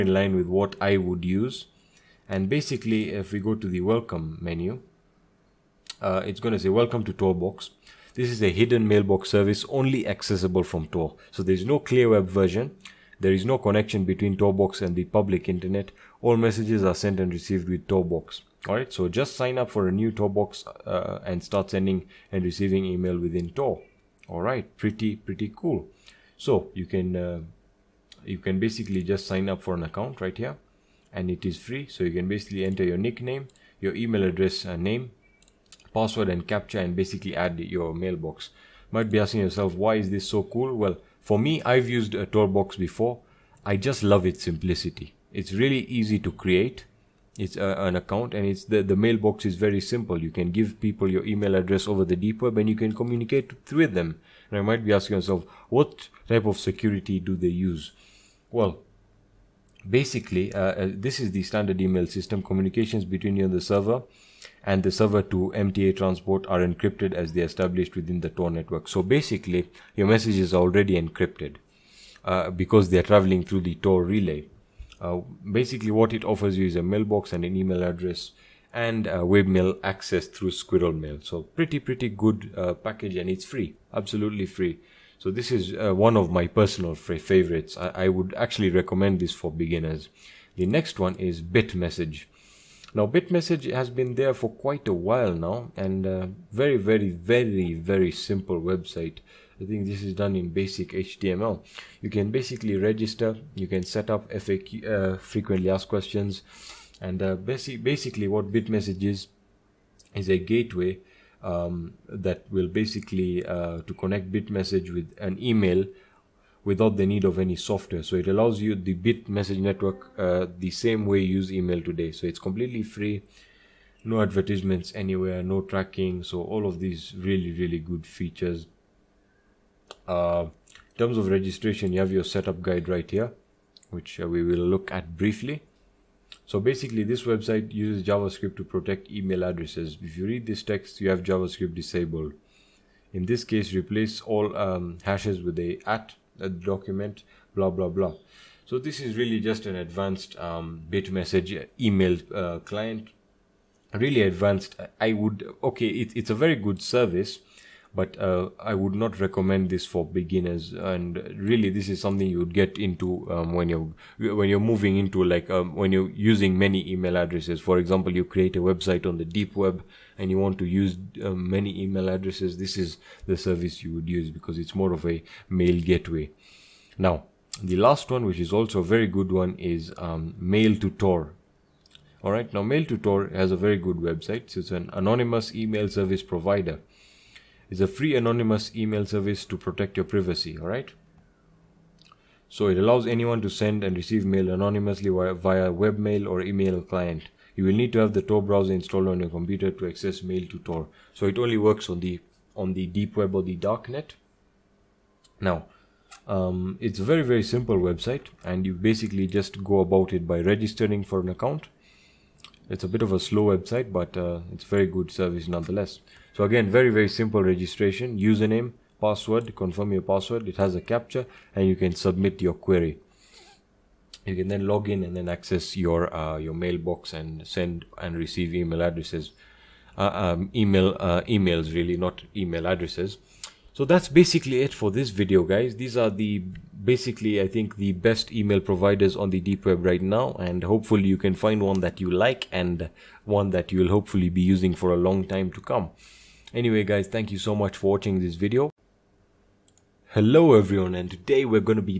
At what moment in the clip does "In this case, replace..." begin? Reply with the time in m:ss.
2:23.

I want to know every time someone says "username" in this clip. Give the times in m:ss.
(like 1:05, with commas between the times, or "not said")
3:38.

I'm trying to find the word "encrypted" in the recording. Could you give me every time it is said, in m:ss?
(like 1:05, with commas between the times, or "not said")
1:06, 1:11.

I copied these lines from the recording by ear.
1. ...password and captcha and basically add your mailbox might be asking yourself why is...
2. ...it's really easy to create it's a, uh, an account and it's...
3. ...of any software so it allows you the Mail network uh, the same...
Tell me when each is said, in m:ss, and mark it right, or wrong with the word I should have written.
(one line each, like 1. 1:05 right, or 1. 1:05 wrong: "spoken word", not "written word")
1. 0:35 right
2. 0:45 right
3. 1:57 wrong: "Bitmessage", not "Mail".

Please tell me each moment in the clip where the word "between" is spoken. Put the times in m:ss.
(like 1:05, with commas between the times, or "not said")
0:14, 1:03.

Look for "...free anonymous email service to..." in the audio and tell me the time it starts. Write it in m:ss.
3:07.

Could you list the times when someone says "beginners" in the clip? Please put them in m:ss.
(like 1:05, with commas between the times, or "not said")
1:29, 2:40.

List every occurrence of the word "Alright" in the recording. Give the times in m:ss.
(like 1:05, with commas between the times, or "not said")
0:18, 0:24.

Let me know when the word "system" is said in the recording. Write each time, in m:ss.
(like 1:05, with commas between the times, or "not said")
1:02.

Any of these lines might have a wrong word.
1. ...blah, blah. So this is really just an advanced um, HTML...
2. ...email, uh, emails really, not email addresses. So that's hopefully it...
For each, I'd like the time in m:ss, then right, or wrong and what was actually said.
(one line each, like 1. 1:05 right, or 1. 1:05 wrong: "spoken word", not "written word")
1. 2:27 wrong: "Bitmessage", not "HTML"
2. 3:50 wrong: "basically", not "hopefully".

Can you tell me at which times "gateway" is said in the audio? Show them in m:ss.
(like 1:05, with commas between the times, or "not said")
1:50, 2:55.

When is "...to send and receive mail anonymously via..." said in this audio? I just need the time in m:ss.
3:13.